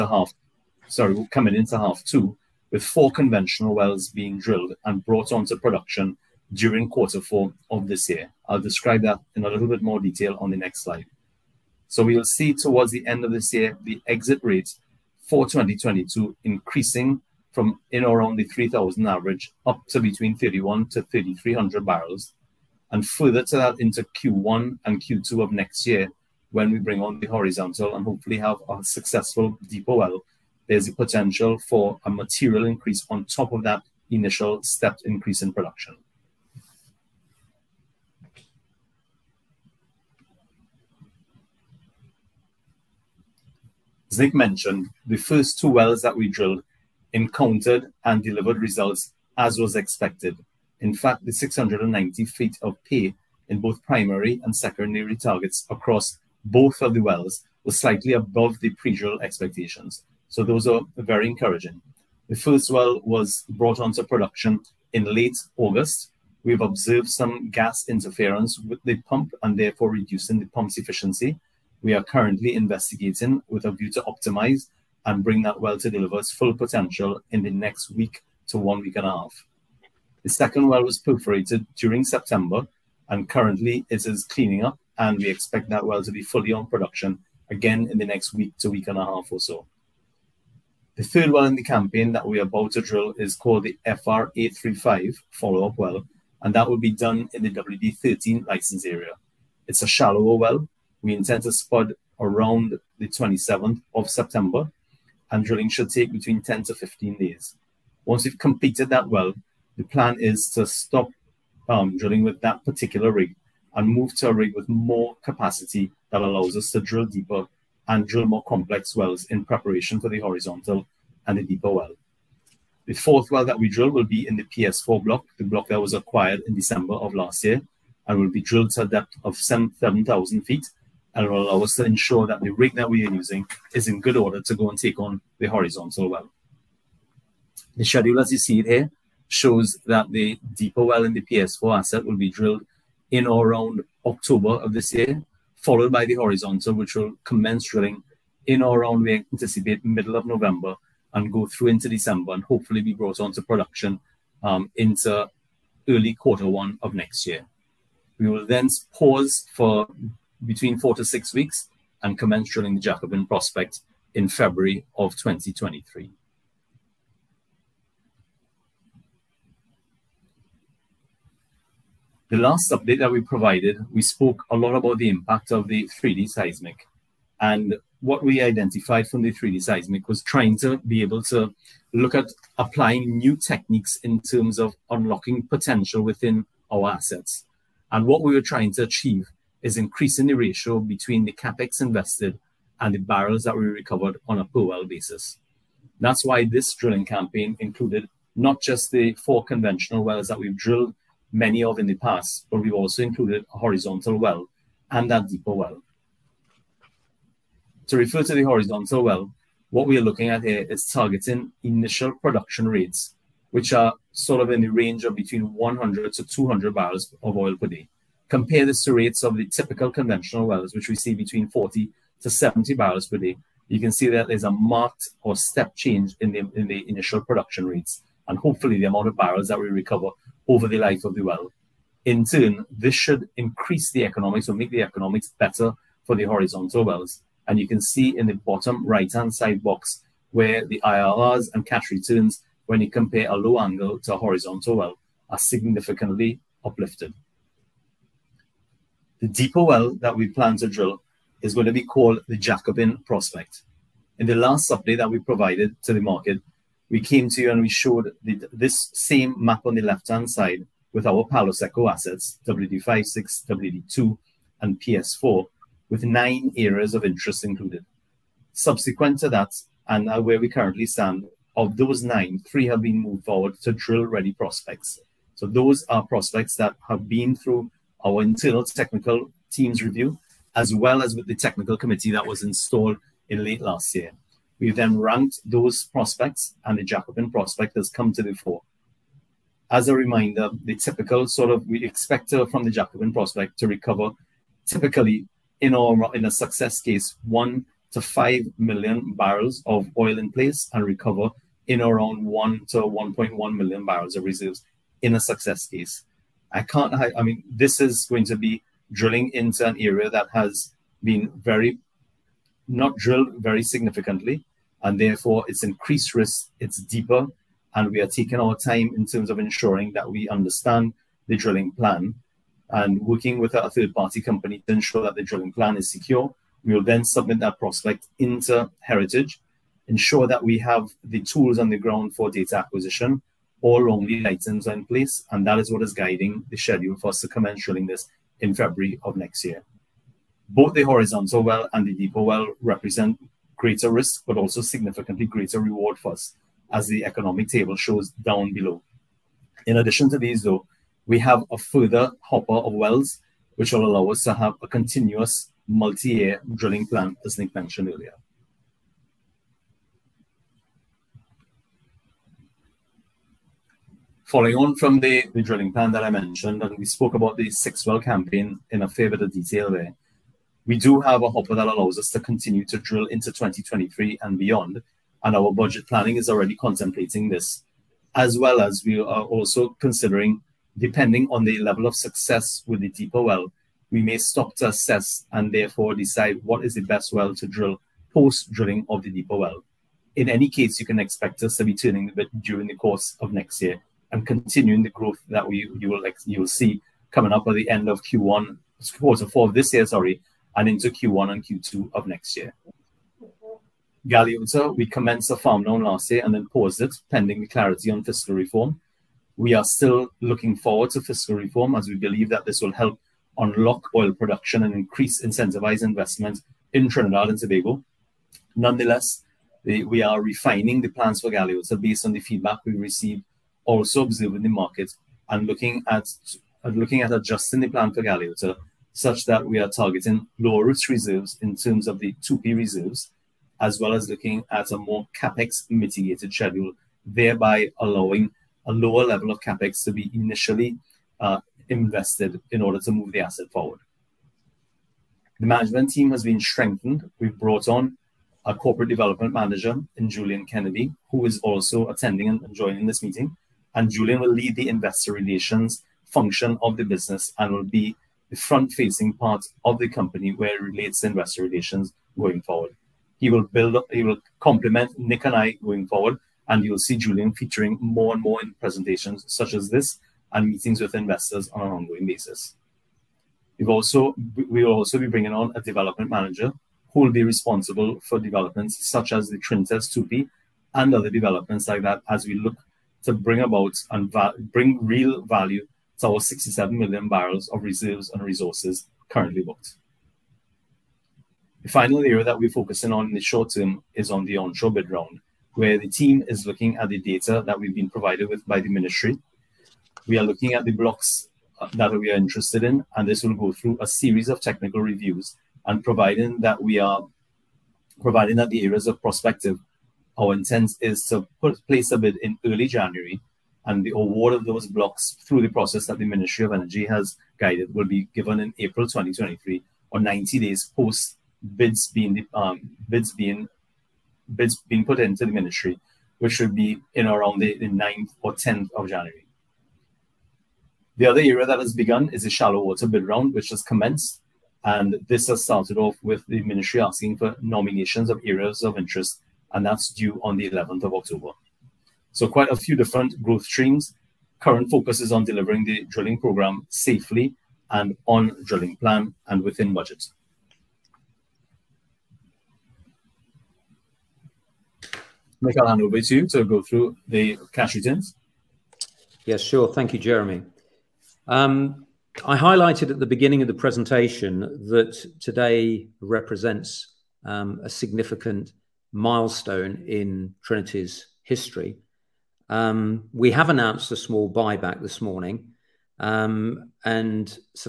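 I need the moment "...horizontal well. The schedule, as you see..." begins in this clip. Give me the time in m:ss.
2:15.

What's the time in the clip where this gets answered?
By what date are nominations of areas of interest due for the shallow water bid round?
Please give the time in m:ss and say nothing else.
9:00.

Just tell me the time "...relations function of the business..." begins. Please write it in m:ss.
7:35.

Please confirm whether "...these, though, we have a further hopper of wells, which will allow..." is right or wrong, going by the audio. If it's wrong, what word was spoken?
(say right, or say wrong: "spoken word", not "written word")
right.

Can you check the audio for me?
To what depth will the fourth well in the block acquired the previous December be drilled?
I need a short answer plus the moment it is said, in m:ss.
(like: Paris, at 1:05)
7,000 feet, at 2:09.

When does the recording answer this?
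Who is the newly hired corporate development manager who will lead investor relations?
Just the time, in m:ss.
7:30.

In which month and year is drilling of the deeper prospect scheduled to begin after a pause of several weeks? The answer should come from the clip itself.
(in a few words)
February 2023.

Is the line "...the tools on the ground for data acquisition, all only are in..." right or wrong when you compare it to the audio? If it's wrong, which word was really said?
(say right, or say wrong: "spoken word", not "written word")
right.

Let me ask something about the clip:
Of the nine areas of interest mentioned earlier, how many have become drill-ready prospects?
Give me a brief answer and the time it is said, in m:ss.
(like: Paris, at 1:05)
3, at 4:32.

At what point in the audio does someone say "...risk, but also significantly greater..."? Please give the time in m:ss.
5:43.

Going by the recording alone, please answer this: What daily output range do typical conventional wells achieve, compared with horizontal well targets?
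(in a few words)
40 to 70 barrels.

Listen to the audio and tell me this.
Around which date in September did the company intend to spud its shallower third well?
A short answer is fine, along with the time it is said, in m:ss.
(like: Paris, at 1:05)
27th of September, at 1:43.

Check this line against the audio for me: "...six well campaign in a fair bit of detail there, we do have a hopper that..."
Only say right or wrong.
right.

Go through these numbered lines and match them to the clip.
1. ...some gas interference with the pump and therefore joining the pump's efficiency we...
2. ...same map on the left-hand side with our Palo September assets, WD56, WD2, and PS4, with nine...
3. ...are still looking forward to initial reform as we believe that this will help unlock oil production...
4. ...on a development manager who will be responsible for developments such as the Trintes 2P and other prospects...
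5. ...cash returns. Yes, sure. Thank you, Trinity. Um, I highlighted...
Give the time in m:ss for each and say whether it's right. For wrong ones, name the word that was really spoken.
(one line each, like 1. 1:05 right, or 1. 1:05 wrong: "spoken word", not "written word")
1. 1:07 wrong: "reducing", not "joining"
2. 4:18 wrong: "Seco", not "September"
3. 6:49 wrong: "fiscal", not "initial"
4. 7:55 wrong: "developments", not "prospects"
5. 9:17 wrong: "Jeremy", not "Trinity".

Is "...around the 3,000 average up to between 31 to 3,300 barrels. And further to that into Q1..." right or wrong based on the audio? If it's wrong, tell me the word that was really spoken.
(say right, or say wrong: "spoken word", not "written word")
right.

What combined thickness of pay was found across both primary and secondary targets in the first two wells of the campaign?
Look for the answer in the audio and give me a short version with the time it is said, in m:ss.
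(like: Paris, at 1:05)
690 feet, at 0:51.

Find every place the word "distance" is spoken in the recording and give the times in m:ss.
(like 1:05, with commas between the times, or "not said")
not said.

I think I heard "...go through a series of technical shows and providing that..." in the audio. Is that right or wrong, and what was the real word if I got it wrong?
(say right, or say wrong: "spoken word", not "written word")
wrong: "reviews", not "shows".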